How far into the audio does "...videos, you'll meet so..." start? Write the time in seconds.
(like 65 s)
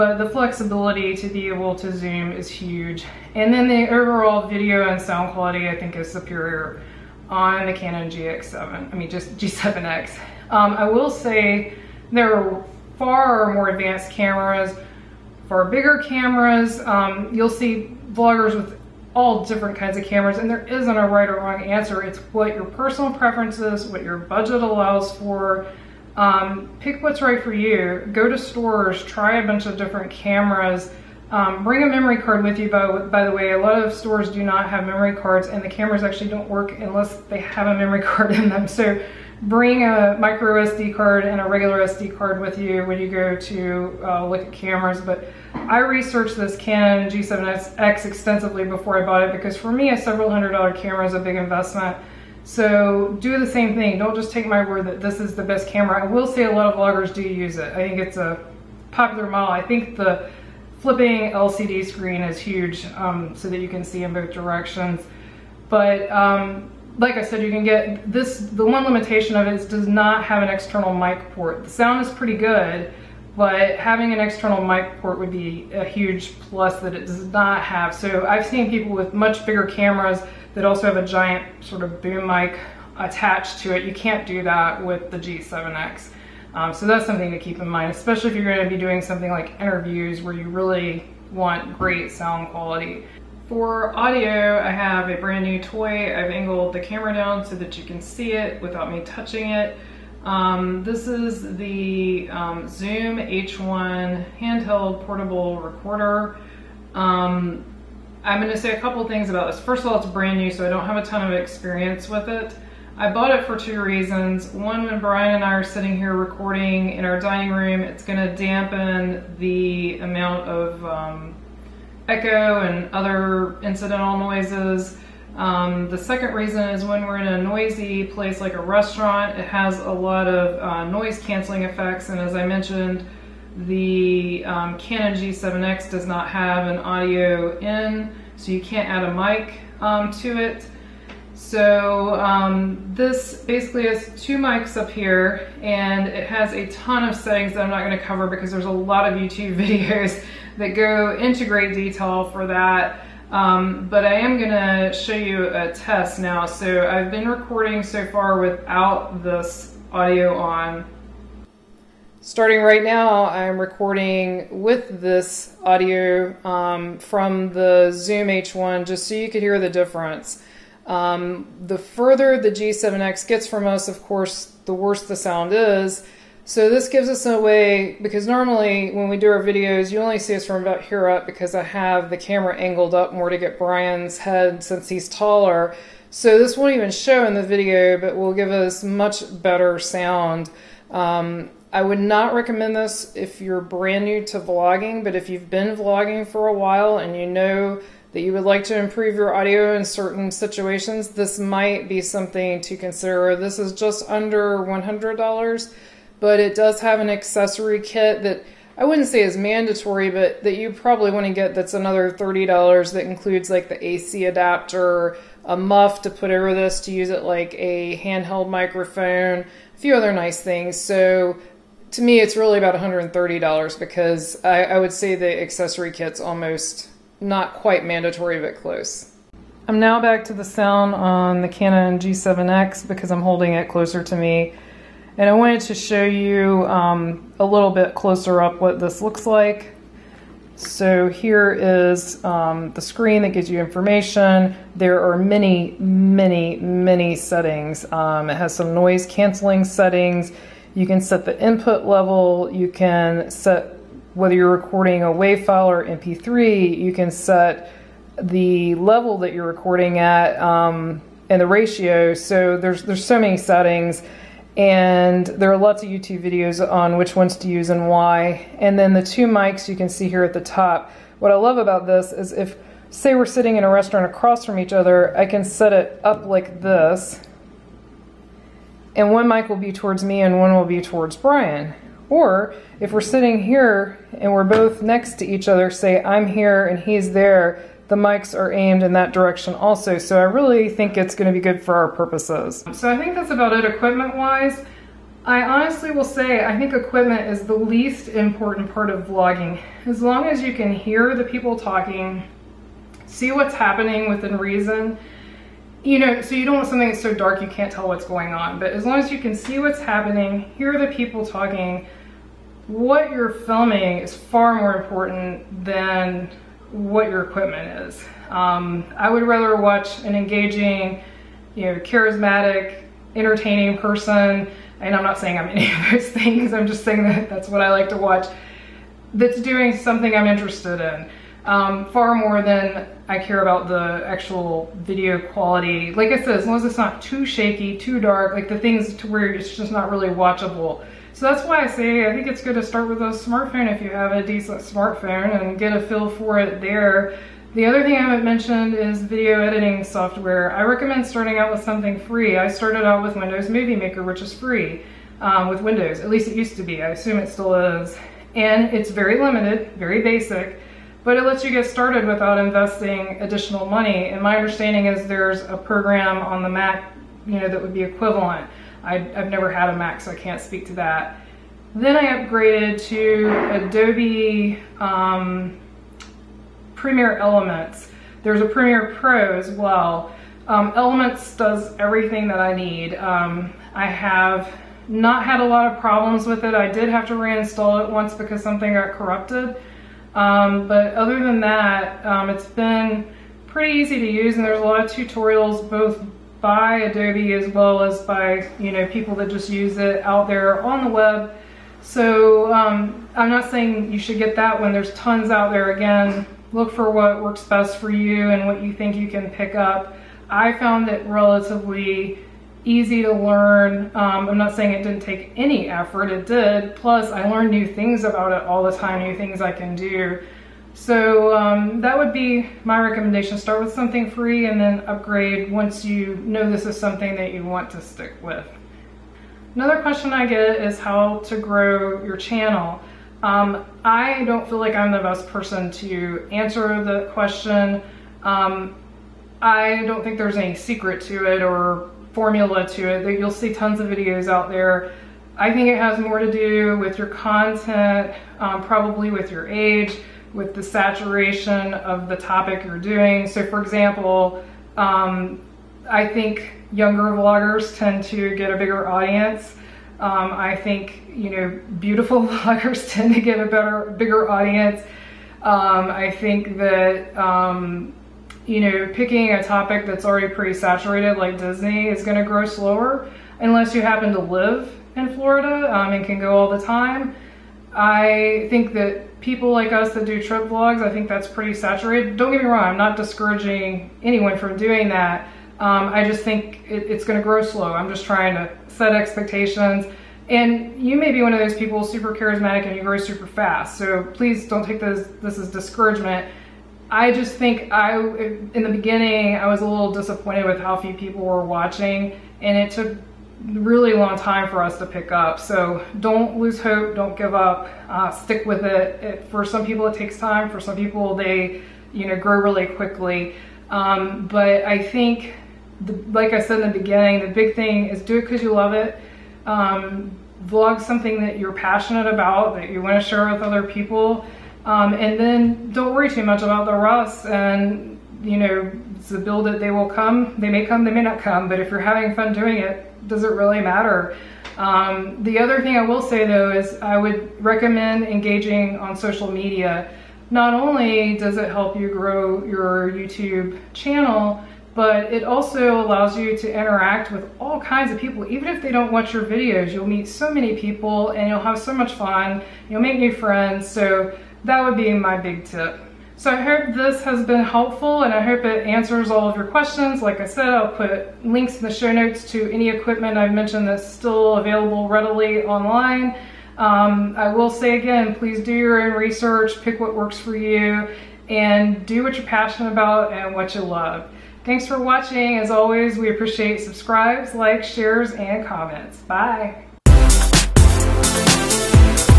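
549 s.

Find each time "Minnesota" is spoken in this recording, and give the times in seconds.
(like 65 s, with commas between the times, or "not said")
not said.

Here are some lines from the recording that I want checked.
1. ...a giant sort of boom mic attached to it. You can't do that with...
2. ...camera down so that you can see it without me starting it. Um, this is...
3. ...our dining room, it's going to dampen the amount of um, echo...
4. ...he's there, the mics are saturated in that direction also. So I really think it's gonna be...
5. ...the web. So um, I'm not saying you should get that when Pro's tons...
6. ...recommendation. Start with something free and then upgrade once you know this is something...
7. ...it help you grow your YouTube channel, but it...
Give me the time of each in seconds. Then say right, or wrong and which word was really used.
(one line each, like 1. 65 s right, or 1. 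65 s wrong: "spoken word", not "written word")
1. 80 s right
2. 96 s wrong: "touching", not "starting"
3. 117 s right
4. 286 s wrong: "aimed", not "saturated"
5. 400 s wrong: "There", not "Pro"
6. 422 s right
7. 541 s right.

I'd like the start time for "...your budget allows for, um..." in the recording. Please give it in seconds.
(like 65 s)
24 s.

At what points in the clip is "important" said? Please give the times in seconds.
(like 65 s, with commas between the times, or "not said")
298 s, 314 s.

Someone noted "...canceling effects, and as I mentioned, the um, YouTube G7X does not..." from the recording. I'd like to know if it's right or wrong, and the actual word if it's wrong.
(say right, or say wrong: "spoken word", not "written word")
wrong: "Canon", not "YouTube".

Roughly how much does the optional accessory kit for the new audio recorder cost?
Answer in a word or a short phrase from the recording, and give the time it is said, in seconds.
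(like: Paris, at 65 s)
$30, at 211 s.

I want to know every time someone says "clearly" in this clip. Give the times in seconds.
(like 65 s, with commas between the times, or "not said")
not said.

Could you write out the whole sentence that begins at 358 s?
And it's very limited, very basic but it lets you get started without investing additional money.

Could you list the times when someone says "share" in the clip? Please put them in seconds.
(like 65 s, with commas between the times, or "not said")
523 s, 577 s.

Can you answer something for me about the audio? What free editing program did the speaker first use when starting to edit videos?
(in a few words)
Windows Movie Maker.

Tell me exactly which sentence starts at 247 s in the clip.
Um, it has some noise canceling settings.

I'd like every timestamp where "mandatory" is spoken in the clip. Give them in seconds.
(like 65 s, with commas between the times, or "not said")
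209 s, 227 s.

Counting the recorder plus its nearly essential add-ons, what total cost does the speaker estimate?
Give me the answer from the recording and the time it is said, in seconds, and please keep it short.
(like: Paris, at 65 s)
$130, at 222 s.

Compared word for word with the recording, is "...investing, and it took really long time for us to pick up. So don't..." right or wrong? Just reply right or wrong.
wrong.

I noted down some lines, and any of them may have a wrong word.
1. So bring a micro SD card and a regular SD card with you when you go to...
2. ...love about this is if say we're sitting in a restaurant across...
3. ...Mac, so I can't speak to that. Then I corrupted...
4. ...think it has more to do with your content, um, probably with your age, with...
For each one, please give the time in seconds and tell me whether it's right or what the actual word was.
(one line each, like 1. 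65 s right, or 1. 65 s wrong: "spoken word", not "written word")
1. 38 s right
2. 271 s right
3. 369 s wrong: "upgraded", not "corrupted"
4. 445 s right.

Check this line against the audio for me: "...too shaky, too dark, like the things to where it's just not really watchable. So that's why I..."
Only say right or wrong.
right.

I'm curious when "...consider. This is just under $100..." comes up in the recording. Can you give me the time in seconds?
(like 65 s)
202 s.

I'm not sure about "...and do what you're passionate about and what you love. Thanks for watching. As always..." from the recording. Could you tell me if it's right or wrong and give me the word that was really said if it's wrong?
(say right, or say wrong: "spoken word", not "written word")
right.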